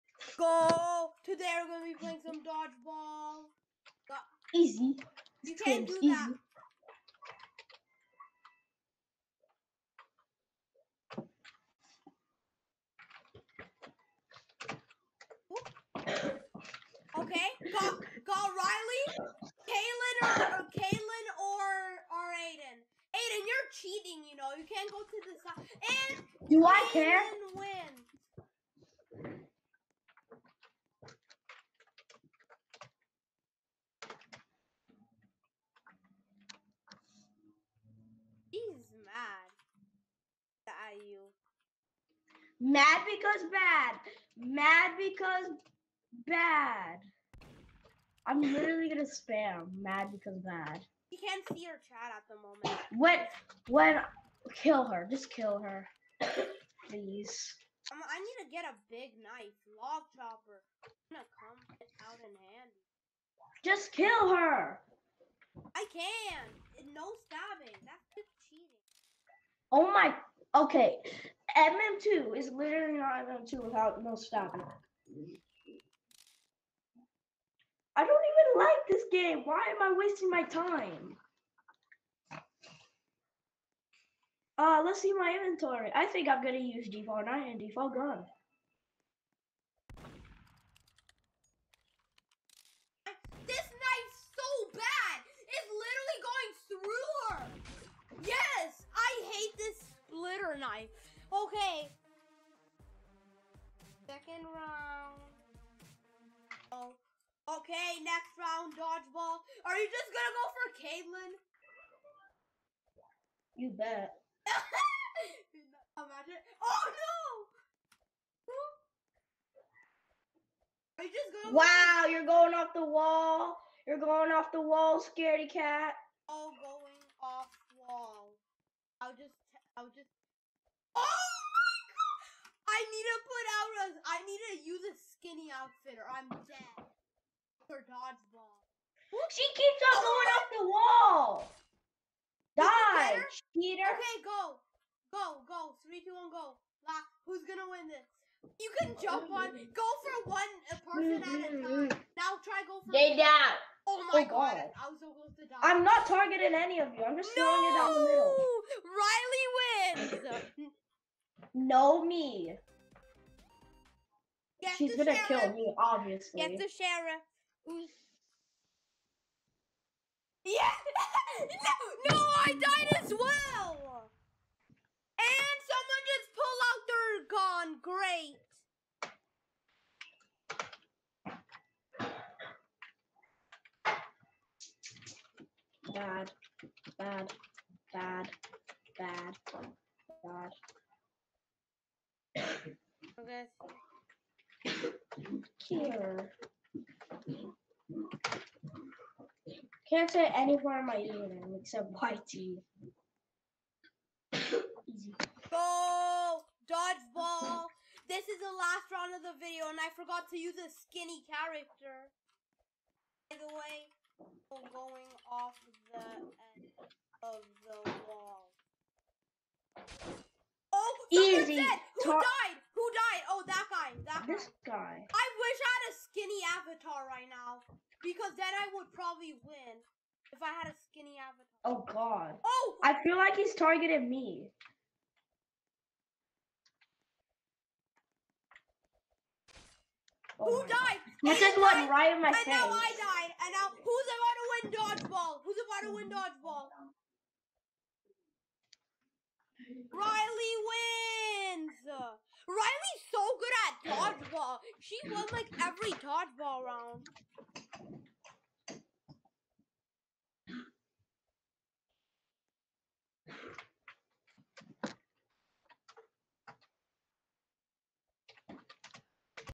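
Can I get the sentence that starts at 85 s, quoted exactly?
I think I'm gonna use default 9 and default gun.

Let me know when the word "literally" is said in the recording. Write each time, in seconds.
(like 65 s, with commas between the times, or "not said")
48 s, 72 s, 96 s.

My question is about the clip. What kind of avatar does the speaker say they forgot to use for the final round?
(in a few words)
skinny character.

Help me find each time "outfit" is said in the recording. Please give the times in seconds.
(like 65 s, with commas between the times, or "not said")
135 s.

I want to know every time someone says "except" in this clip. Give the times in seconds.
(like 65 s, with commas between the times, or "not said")
201 s.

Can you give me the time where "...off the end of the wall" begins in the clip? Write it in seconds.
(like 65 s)
215 s.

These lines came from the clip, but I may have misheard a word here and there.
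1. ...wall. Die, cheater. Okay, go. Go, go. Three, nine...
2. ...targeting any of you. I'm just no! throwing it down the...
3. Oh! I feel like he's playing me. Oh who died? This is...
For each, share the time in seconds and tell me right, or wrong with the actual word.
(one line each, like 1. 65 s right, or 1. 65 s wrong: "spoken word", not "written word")
1. 140 s wrong: "two", not "nine"
2. 156 s right
3. 232 s wrong: "targeting", not "playing".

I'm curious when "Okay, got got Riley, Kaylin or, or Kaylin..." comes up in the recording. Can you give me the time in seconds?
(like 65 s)
17 s.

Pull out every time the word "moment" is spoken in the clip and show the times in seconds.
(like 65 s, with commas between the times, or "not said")
52 s.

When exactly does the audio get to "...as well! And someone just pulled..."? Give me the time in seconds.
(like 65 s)
173 s.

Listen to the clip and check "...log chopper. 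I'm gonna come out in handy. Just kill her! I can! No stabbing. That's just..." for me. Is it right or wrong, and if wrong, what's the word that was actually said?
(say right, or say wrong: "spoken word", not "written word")
right.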